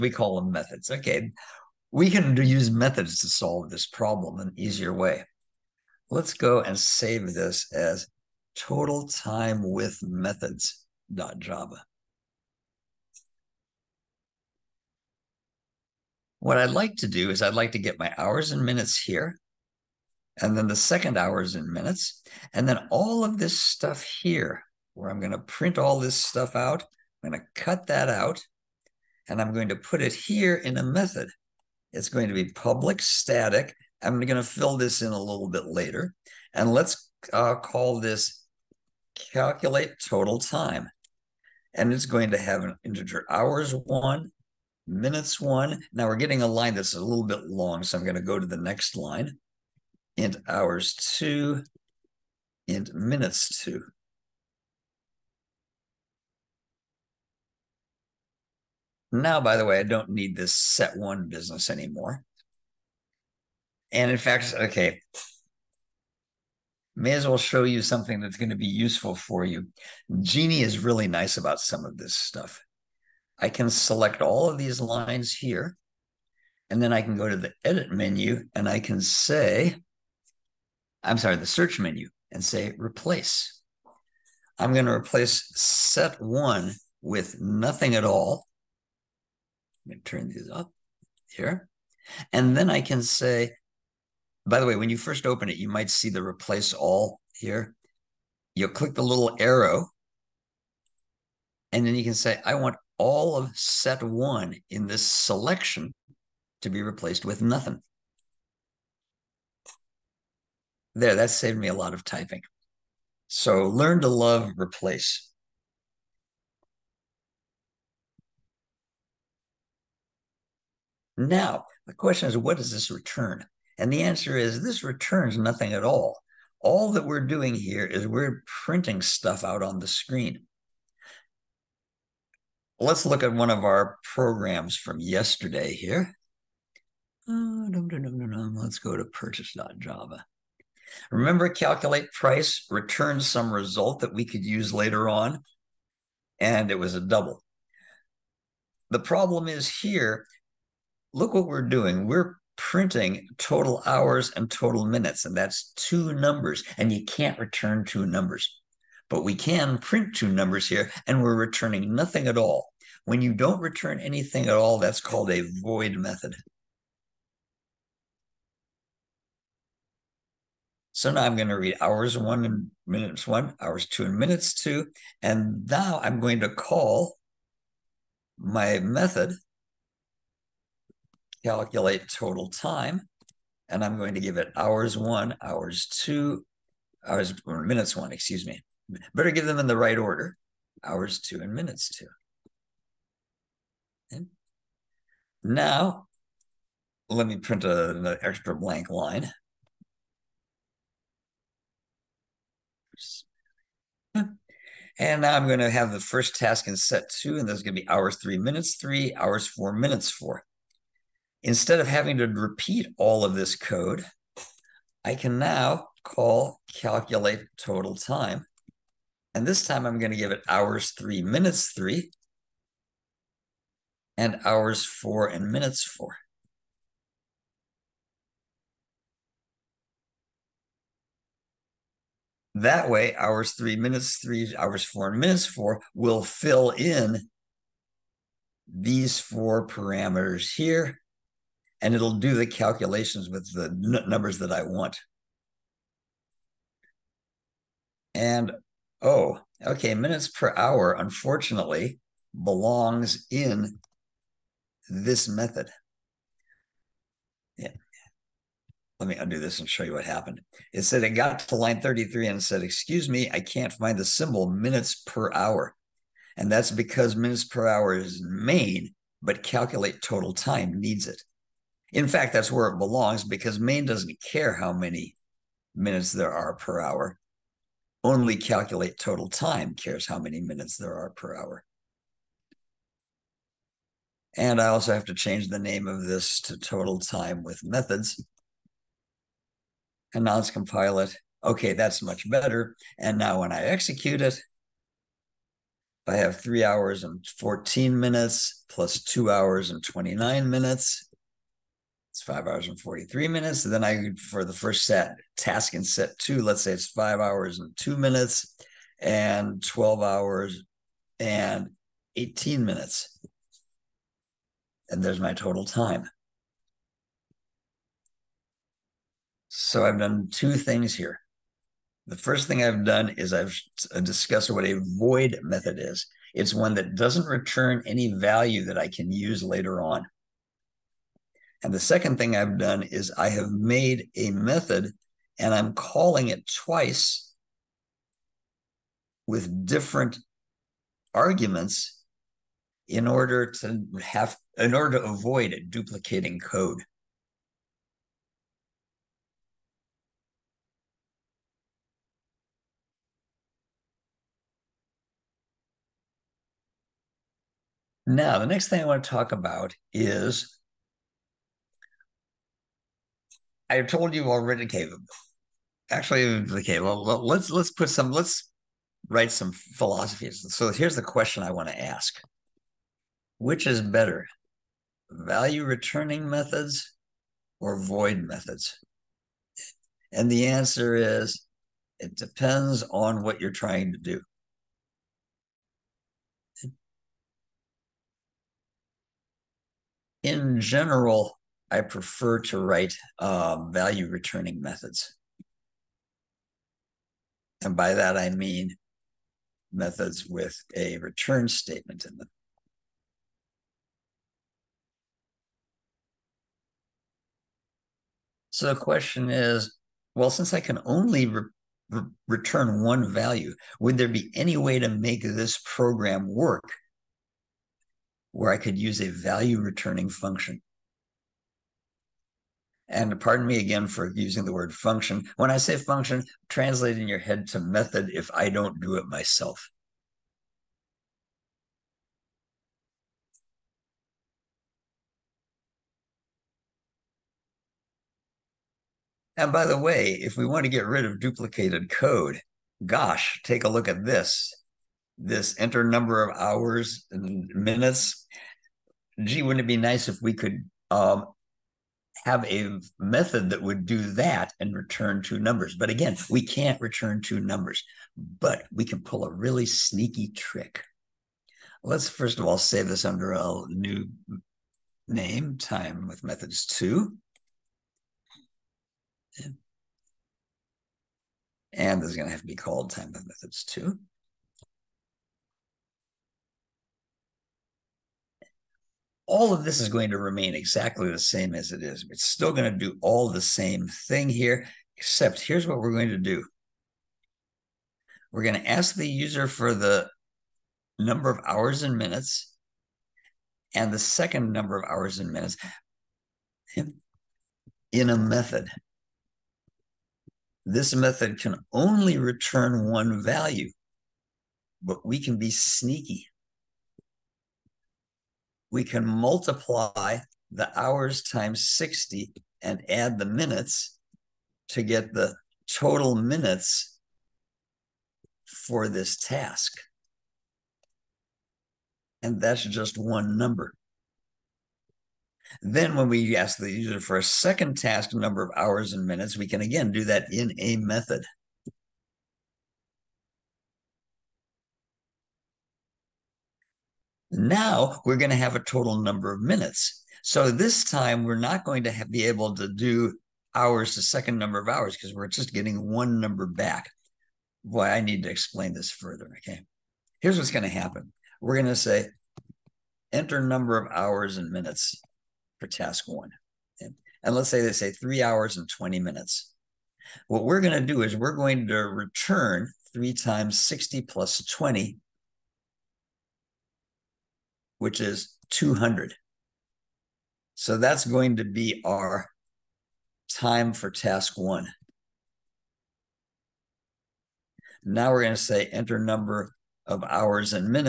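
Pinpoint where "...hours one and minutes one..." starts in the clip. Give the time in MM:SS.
02:51.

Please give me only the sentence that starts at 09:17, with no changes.
And let's say they say three hours and 20 minutes.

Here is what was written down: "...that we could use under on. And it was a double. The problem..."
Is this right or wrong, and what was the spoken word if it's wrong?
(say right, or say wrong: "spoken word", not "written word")
wrong: "later", not "under".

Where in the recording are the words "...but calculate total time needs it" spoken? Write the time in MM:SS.
04:29.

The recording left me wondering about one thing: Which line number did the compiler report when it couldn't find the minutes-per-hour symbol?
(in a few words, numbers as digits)
33.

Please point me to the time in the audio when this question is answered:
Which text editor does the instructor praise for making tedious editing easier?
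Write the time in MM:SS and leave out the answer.
01:10.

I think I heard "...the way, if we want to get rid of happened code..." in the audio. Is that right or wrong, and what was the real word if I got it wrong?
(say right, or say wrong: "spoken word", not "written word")
wrong: "duplicated", not "happened".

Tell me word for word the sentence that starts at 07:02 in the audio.
And pardon me again for using the word function.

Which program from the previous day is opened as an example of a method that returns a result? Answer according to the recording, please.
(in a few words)
purchase.java.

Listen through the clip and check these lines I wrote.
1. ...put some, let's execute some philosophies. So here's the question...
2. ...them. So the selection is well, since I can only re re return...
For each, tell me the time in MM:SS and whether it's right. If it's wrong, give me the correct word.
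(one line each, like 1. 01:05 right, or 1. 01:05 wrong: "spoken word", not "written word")
1. 06:07 wrong: "write", not "execute"
2. 06:42 wrong: "question", not "selection".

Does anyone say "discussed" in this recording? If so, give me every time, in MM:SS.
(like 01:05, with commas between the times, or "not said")
05:24.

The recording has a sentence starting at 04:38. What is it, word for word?
Only calculate total time cares how many minutes there are per hour.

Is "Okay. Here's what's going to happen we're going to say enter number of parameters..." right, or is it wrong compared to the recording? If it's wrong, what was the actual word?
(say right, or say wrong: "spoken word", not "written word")
wrong: "hours", not "parameters".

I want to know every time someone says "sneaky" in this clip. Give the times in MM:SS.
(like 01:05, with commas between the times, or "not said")
07:39, 08:25.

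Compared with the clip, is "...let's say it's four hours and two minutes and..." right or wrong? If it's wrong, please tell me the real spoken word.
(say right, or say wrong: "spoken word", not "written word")
wrong: "five", not "four".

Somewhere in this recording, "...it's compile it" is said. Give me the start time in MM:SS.
04:50.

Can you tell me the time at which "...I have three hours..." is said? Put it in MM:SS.
04:56.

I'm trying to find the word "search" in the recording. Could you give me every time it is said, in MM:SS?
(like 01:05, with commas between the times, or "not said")
01:21.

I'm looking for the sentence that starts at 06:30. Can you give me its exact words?
in general, I prefer to write uh, value returning methods.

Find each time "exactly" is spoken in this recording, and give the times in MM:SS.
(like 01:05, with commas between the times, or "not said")
08:00.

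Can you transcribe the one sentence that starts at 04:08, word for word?
And oh, okay, minutes per hour, unfortunately, belongs in this method.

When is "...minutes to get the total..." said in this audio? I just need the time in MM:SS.
08:33.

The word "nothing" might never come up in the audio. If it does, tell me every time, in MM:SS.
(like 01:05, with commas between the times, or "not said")
01:27, 01:47, 02:05, 02:41.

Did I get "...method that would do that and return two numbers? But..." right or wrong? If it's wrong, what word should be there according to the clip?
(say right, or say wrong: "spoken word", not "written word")
right.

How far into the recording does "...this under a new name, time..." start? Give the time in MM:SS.
07:42.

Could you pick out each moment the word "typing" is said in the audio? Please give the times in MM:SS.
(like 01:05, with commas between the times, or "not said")
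01:52.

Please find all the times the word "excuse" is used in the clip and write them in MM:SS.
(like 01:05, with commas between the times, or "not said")
03:08, 04:22.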